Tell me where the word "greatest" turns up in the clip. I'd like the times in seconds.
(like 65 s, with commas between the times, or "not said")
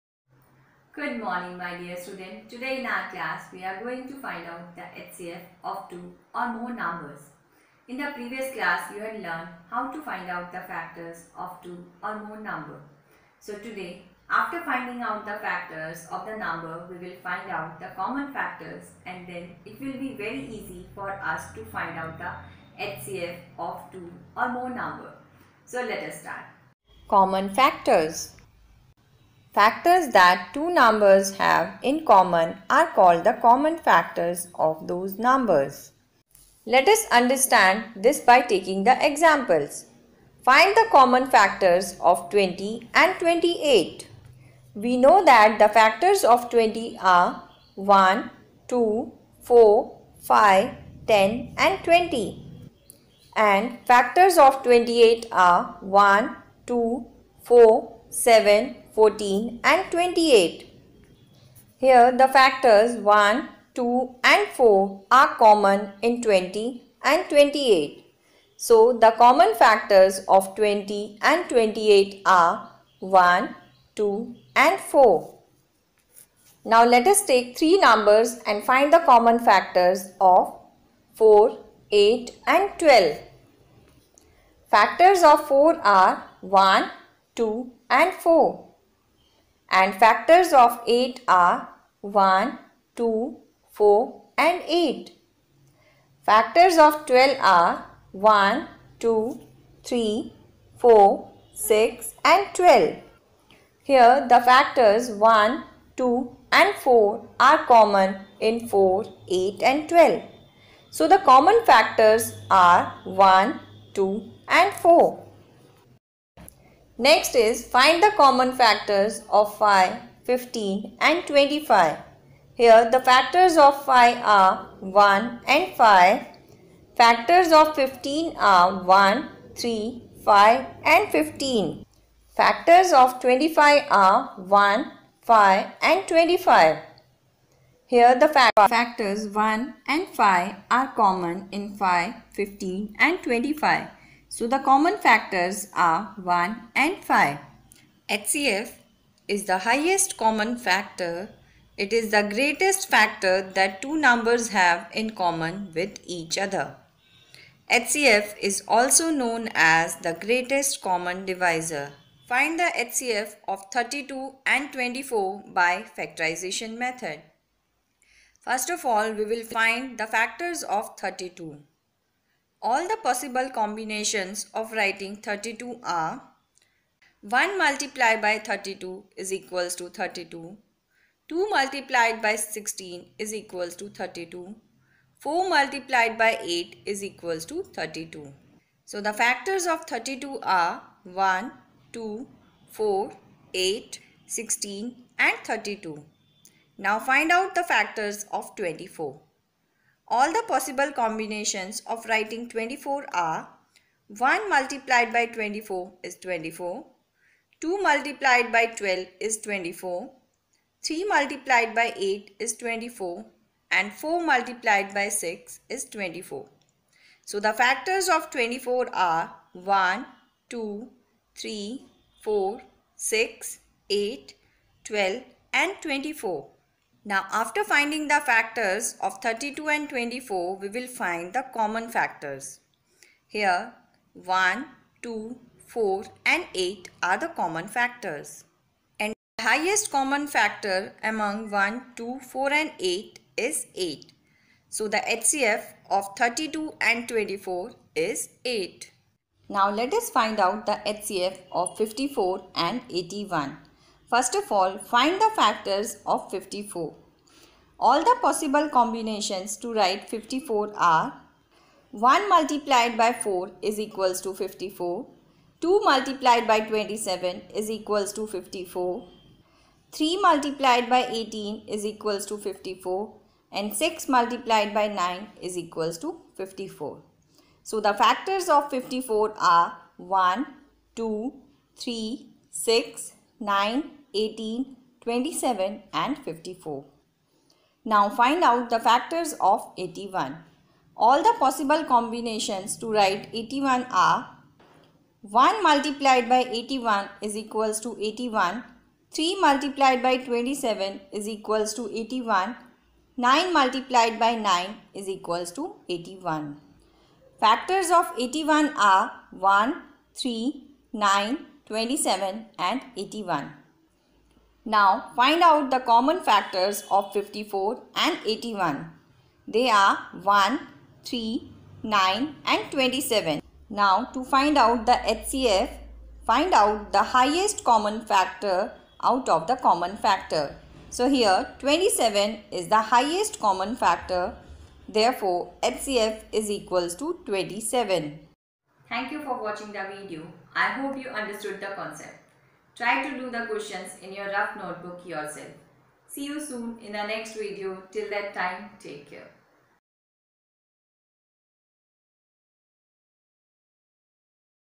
152 s, 160 s.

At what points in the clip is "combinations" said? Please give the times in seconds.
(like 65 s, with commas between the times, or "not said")
173 s, 200 s, 258 s.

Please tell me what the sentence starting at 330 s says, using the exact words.
So here 27 is the highest common factor.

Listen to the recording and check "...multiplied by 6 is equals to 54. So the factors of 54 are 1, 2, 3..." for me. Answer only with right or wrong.
wrong.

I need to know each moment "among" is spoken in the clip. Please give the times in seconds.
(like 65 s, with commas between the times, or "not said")
241 s.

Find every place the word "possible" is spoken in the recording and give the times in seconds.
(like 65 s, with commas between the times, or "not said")
173 s, 200 s, 258 s.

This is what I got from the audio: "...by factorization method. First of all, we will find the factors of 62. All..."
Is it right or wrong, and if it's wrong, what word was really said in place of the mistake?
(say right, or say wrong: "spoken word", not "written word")
wrong: "32", not "62".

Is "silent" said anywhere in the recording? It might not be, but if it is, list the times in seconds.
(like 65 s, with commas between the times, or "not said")
not said.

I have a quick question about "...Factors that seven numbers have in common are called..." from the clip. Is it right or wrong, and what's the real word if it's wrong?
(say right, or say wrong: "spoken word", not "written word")
wrong: "two", not "seven".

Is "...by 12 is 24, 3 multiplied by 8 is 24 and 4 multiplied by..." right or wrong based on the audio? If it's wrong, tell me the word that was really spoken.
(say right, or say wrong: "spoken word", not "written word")
right.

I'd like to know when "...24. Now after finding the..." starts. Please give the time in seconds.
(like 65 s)
225 s.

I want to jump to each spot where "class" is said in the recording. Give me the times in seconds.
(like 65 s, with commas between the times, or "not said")
3 s, 8 s.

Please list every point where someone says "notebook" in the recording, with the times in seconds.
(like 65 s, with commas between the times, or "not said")
344 s.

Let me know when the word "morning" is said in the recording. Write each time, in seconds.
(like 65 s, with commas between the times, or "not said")
1 s.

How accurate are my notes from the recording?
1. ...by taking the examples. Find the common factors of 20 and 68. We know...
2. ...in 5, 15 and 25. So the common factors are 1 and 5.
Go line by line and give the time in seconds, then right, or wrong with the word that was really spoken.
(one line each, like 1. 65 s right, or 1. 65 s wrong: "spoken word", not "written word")
1. 38 s wrong: "28", not "68"
2. 141 s right.